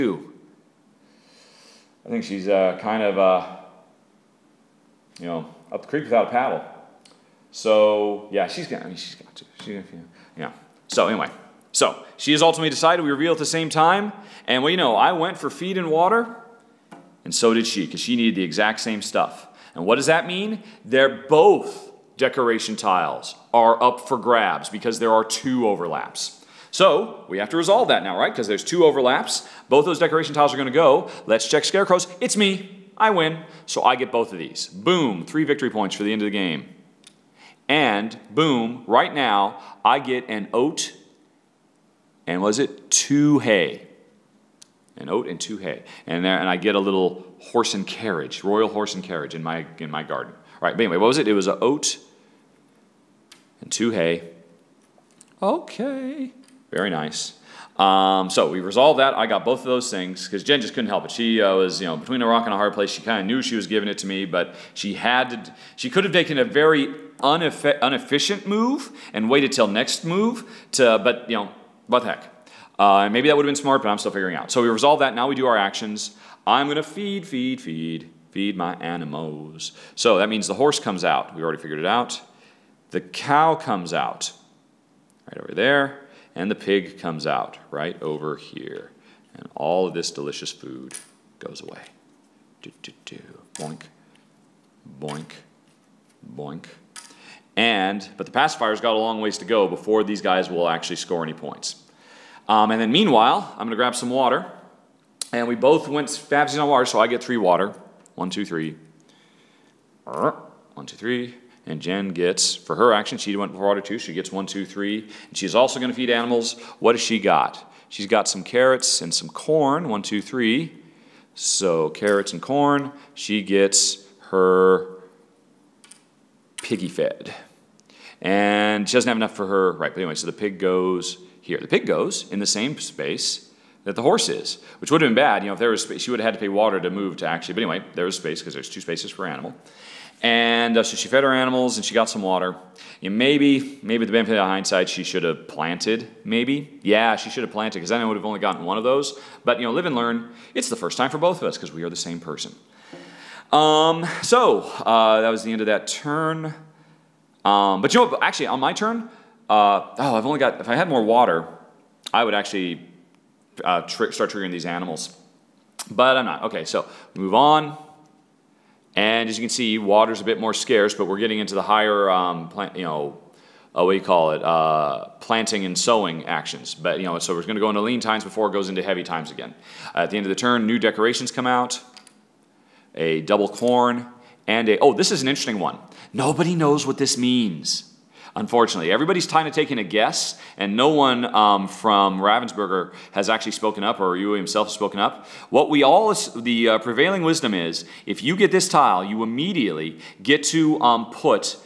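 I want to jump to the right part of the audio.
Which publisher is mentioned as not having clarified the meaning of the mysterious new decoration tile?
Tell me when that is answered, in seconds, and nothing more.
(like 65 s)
192 s.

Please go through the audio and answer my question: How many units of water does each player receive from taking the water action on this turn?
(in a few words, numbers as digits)
3.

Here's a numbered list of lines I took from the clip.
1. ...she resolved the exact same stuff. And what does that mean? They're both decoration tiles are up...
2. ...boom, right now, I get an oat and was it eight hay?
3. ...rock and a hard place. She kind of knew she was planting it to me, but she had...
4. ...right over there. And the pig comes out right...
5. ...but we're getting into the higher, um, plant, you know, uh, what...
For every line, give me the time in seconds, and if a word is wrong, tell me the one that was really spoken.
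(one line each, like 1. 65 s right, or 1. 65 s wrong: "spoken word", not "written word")
1. 18 s wrong: "needed", not "resolved"
2. 38 s wrong: "two", not "eight"
3. 62 s wrong: "giving", not "planting"
4. 85 s right
5. 170 s right.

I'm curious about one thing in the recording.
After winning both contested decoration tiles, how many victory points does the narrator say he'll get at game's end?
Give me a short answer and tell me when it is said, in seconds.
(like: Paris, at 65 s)
3, at 35 s.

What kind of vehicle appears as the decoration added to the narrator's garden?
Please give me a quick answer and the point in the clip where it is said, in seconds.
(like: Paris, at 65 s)
royal horse and carriage, at 48 s.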